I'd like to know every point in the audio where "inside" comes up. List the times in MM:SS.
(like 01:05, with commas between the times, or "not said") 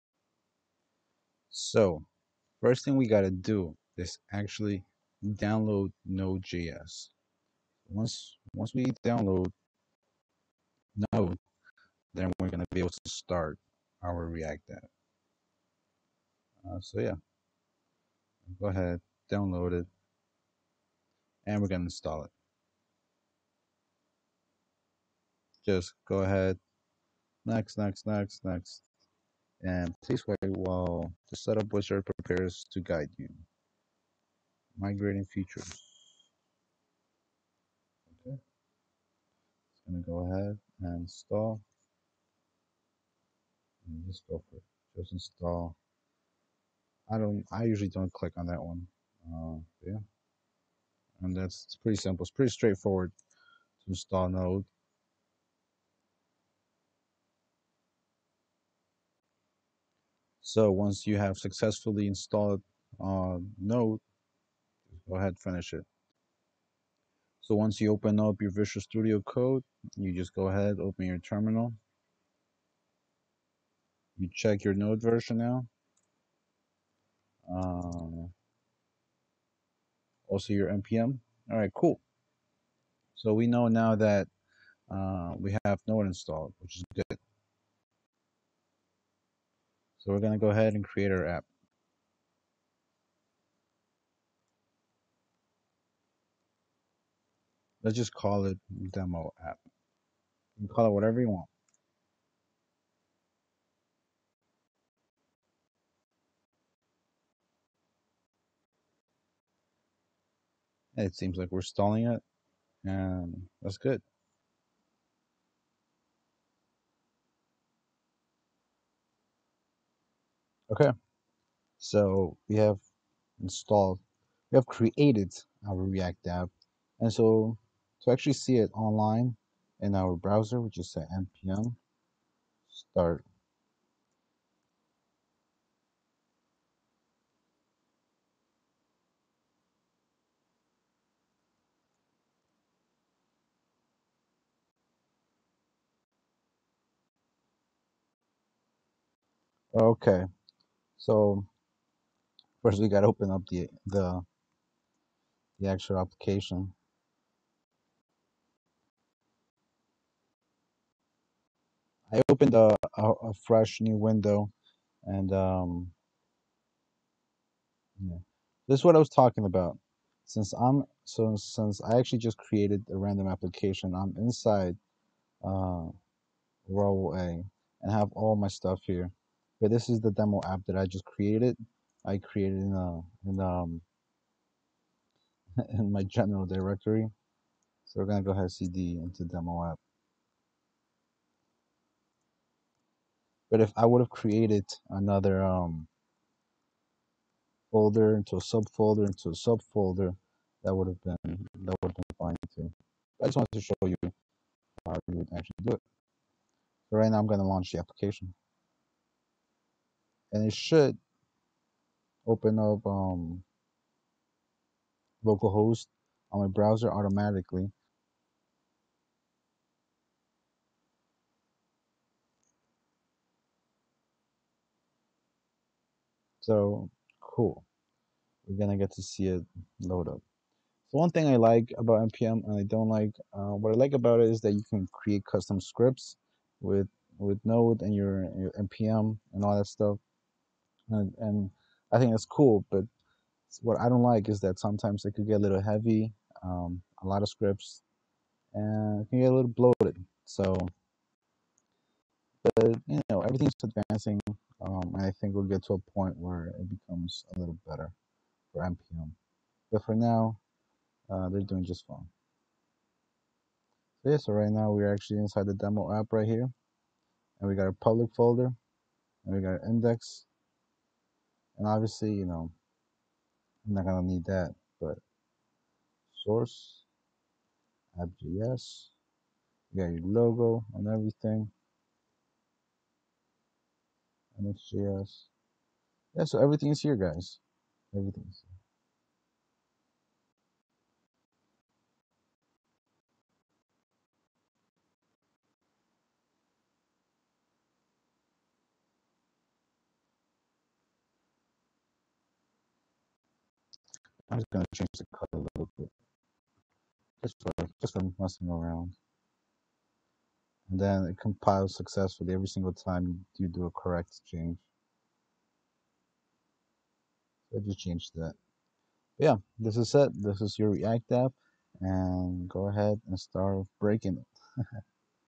02:54, 04:25.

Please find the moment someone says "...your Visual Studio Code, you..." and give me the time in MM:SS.
01:08.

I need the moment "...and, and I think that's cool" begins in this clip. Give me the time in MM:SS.
04:00.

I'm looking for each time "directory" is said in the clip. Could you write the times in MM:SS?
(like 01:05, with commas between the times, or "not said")
03:06.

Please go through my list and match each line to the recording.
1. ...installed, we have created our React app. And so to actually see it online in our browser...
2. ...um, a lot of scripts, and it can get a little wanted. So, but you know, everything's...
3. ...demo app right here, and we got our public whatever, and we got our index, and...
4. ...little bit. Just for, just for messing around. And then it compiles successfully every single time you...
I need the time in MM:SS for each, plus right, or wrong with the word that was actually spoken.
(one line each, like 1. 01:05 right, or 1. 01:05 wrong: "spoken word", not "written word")
1. 02:03 right
2. 04:06 wrong: "bloated", not "wanted"
3. 04:25 wrong: "folder", not "whatever"
4. 05:05 right.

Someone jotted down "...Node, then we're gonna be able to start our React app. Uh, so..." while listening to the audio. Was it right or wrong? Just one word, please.
right.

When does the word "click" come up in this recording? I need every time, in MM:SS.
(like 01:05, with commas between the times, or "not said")
00:48.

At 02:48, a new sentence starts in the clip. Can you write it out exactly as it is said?
this is what I was talking about.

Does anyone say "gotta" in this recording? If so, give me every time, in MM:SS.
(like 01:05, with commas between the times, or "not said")
00:03, 02:32.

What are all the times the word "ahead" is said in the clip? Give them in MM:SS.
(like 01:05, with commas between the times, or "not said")
00:18, 00:26, 00:40, 01:05, 01:10, 01:30, 03:08, 05:22.